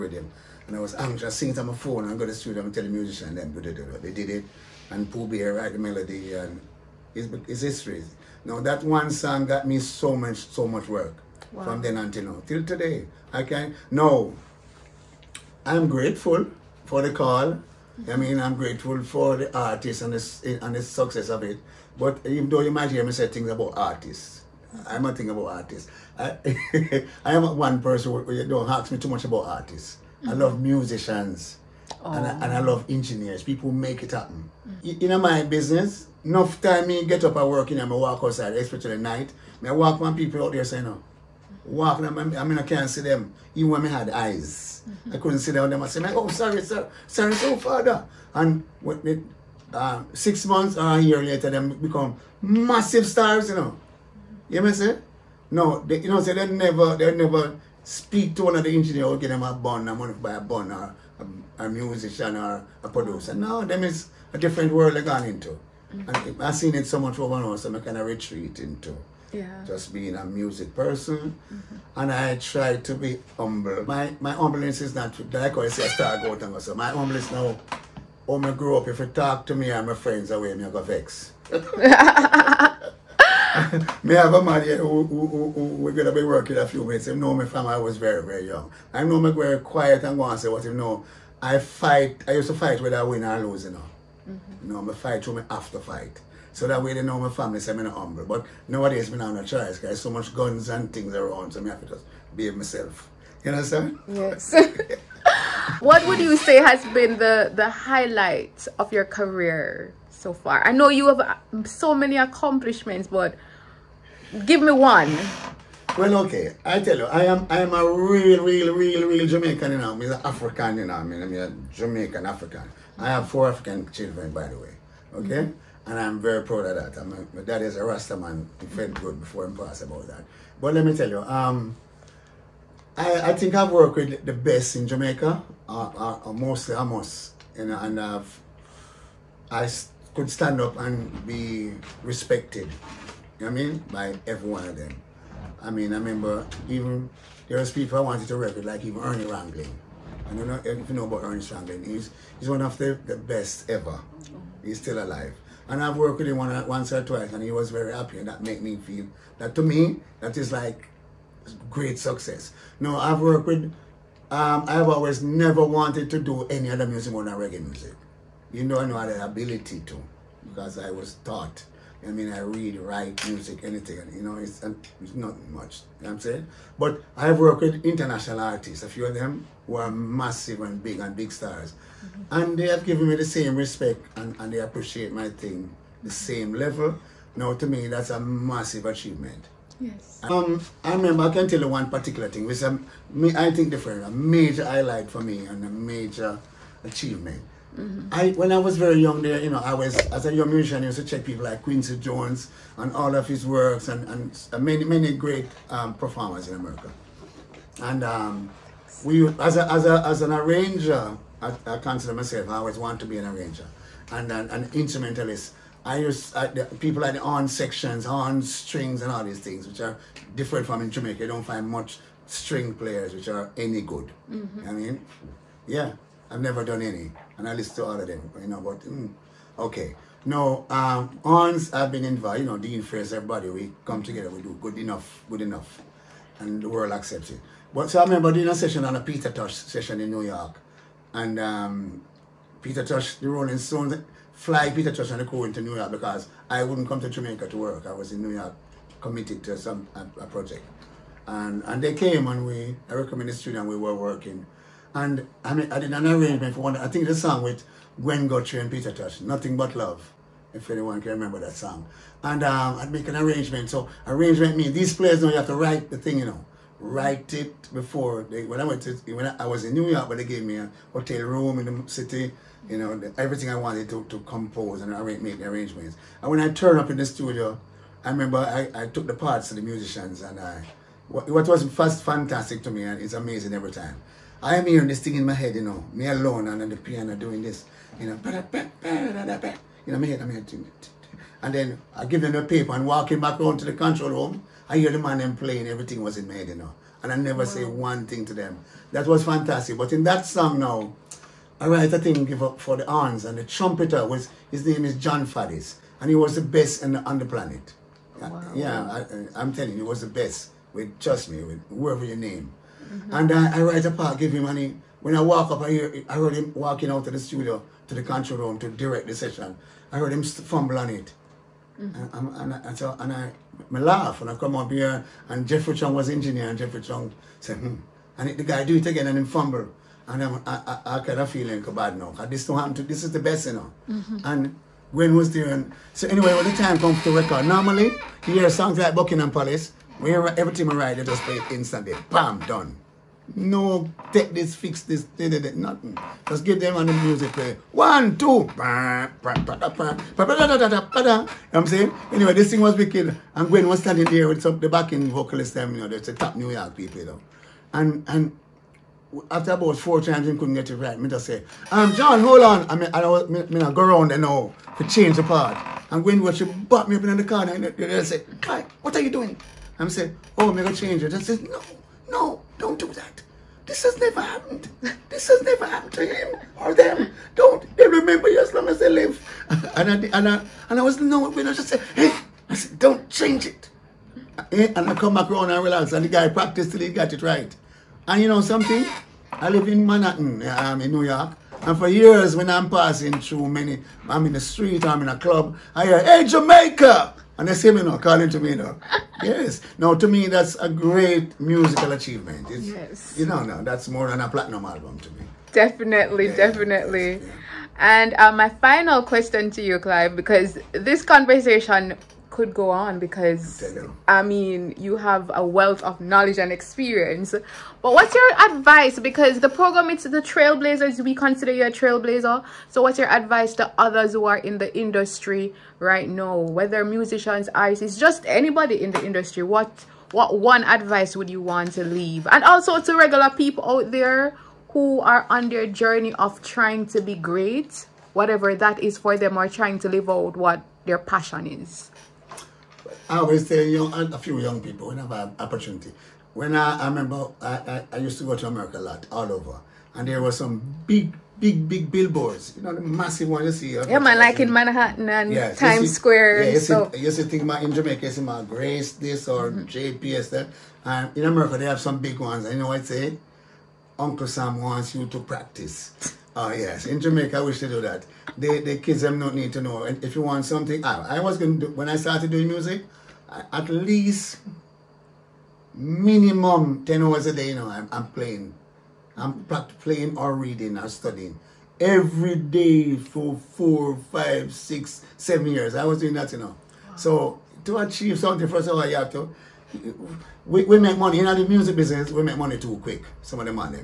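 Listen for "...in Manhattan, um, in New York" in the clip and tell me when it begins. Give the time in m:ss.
6:29.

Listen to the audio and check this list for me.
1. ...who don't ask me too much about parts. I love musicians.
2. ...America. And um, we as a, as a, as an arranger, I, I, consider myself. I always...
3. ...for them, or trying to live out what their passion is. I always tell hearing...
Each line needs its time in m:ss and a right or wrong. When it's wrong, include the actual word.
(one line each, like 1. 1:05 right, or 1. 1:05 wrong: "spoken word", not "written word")
1. 0:28 wrong: "artists", not "parts"
2. 3:26 right
3. 7:18 wrong: "young", not "hearing".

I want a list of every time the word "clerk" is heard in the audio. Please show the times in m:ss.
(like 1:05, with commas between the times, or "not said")
not said.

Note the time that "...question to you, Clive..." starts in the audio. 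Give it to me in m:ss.
6:49.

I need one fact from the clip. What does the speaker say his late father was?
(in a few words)
Rasta man.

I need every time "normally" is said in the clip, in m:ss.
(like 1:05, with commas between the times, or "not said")
5:37.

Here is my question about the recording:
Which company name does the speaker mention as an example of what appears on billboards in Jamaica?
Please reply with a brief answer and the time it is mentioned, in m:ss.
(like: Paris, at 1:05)
JPS, at 7:39.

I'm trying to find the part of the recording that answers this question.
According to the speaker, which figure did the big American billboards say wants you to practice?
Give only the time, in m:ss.
7:43.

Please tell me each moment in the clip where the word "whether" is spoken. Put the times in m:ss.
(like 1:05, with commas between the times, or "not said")
1:32, 7:06.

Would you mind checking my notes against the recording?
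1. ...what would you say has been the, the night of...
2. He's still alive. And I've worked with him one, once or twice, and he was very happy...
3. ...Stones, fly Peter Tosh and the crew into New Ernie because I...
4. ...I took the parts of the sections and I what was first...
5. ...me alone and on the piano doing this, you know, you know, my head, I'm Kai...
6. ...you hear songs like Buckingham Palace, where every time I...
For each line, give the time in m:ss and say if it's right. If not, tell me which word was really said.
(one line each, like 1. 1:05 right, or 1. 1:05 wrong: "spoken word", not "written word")
1. 1:45 wrong: "highlight", not "night"
2. 2:34 right
3. 4:03 wrong: "York", not "Ernie"
4. 4:38 wrong: "musicians", not "sections"
5. 4:45 wrong: "And", not "Kai"
6. 5:38 right.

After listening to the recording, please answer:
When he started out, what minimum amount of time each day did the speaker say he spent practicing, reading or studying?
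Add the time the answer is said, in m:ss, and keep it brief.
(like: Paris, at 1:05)
10 hours, at 7:56.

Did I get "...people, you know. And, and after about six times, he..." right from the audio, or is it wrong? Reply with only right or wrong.
wrong.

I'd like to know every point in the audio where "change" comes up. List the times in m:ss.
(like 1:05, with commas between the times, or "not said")
6:04, 6:10, 6:23.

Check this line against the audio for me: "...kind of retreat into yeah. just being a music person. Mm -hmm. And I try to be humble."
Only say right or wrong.
right.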